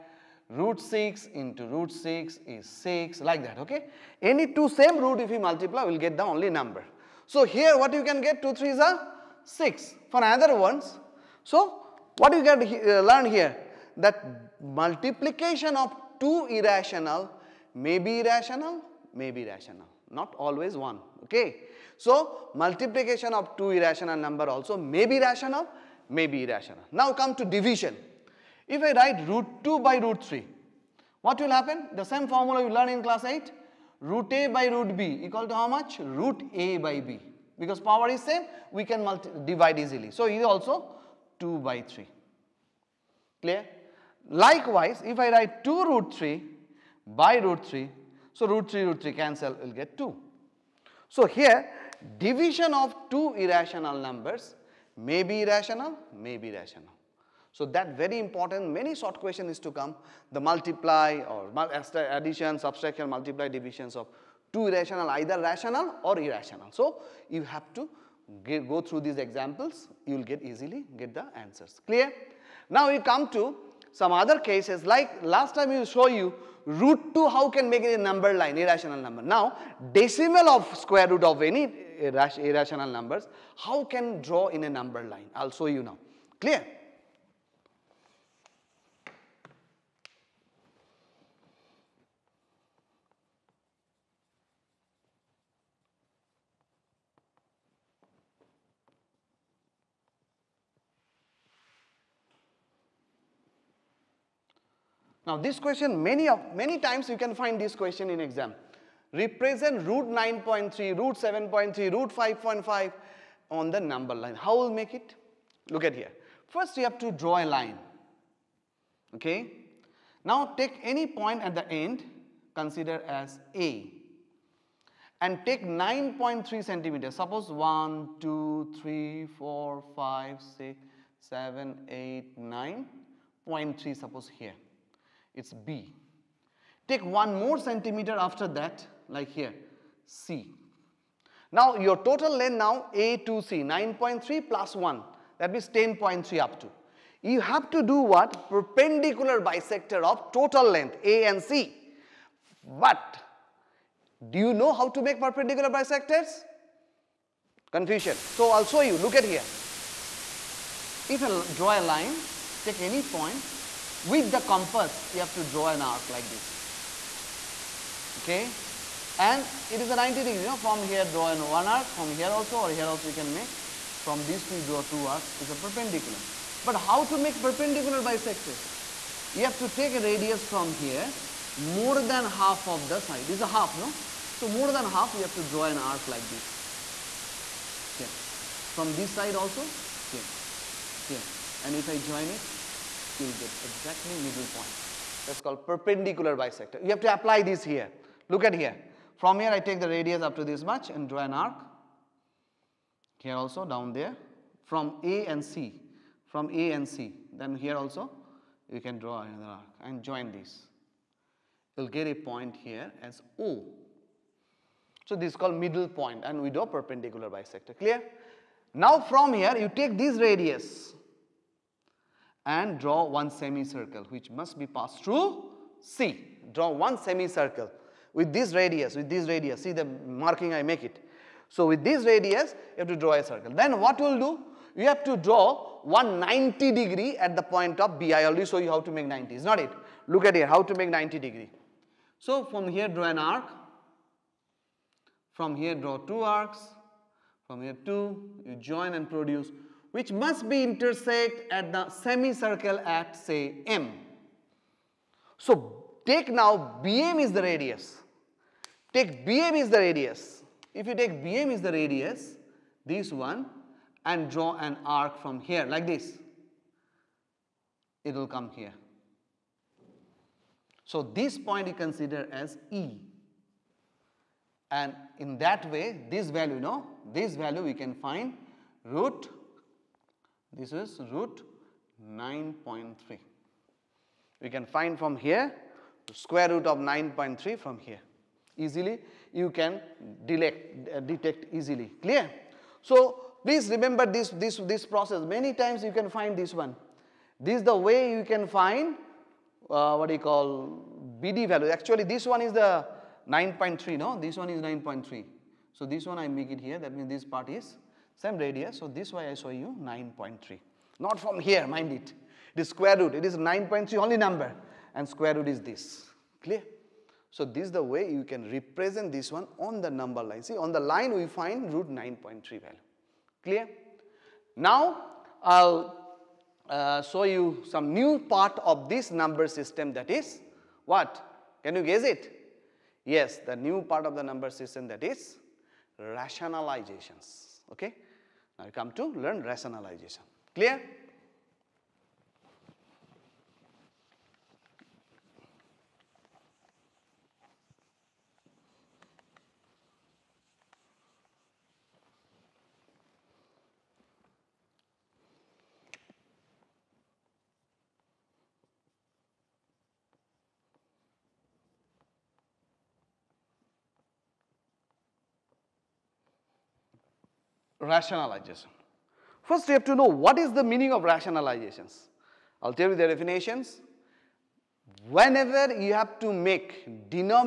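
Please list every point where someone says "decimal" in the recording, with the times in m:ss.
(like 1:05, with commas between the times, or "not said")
1:19.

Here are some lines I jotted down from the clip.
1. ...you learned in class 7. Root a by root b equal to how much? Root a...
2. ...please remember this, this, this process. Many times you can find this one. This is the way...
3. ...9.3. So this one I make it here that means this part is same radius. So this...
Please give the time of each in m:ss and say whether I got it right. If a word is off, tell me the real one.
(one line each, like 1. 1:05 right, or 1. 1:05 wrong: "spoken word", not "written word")
1. 0:32 wrong: "8", not "7"
2. 4:53 right
3. 5:04 right.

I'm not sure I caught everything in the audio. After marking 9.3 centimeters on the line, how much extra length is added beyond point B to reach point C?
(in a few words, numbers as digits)
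1 centimeter.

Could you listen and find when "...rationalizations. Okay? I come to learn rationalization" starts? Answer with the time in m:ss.
5:35.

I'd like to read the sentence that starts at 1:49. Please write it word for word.
Represent root 9.3, root 7.3, root 5.5 on the number line.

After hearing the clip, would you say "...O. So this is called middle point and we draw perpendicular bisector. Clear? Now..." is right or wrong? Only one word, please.
right.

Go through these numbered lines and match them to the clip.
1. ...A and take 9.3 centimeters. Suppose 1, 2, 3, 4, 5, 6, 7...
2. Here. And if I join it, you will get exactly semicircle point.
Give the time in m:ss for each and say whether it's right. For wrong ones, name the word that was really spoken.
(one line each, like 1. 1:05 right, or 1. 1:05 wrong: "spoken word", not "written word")
1. 2:03 right
2. 3:11 wrong: "middle", not "semicircle".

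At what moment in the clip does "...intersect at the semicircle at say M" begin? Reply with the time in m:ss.
4:10.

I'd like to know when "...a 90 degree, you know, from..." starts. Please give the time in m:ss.
2:49.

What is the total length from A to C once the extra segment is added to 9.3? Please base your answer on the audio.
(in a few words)
10.3.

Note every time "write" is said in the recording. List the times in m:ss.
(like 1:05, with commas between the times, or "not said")
0:28, 0:45.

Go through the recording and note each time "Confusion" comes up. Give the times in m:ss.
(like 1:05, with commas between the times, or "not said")
2:37.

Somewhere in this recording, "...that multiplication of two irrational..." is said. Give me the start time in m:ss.
0:13.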